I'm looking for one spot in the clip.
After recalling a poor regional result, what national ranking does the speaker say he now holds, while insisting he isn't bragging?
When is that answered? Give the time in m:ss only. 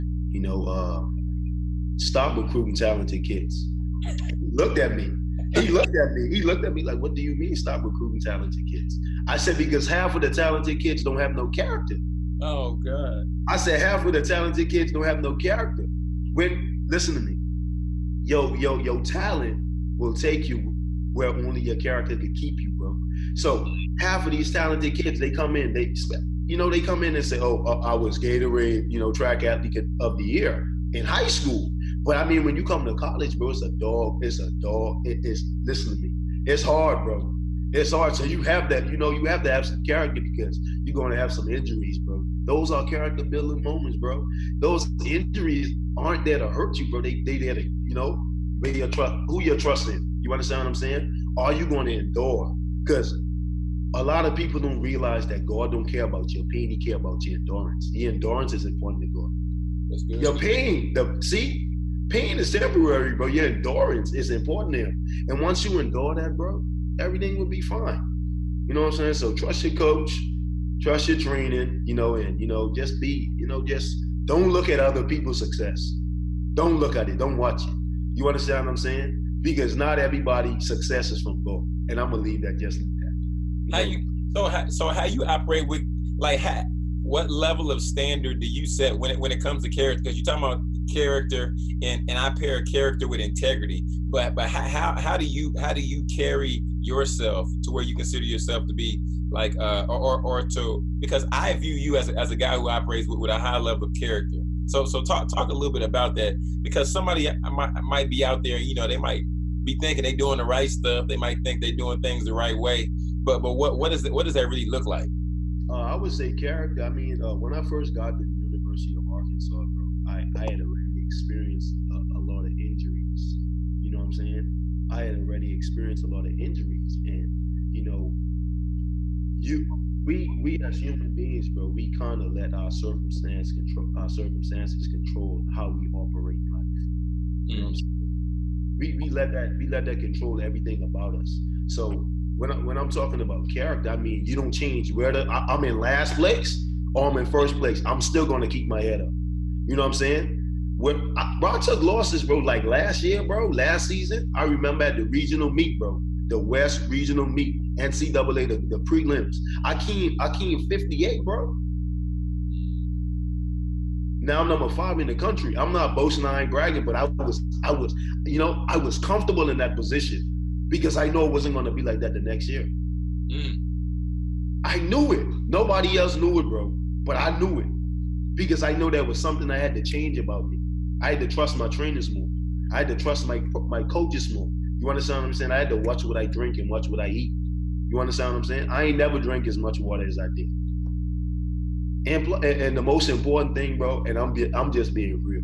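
2:44.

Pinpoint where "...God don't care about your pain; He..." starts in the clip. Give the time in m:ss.
0:55.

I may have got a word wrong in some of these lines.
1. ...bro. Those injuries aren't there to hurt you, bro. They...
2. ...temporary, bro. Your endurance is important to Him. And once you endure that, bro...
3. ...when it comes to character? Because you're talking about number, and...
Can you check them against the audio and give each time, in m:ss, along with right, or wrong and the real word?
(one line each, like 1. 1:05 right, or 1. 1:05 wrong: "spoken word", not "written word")
1. 0:43 right
2. 1:02 right
3. 1:29 wrong: "character", not "number".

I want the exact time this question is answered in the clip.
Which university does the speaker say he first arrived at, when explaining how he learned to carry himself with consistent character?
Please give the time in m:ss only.
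1:58.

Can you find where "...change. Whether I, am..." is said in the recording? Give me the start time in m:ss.
2:24.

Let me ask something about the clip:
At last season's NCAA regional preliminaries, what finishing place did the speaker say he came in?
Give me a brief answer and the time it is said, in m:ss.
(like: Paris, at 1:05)
58, at 2:40.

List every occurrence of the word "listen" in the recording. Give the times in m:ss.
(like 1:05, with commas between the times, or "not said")
0:16, 0:35.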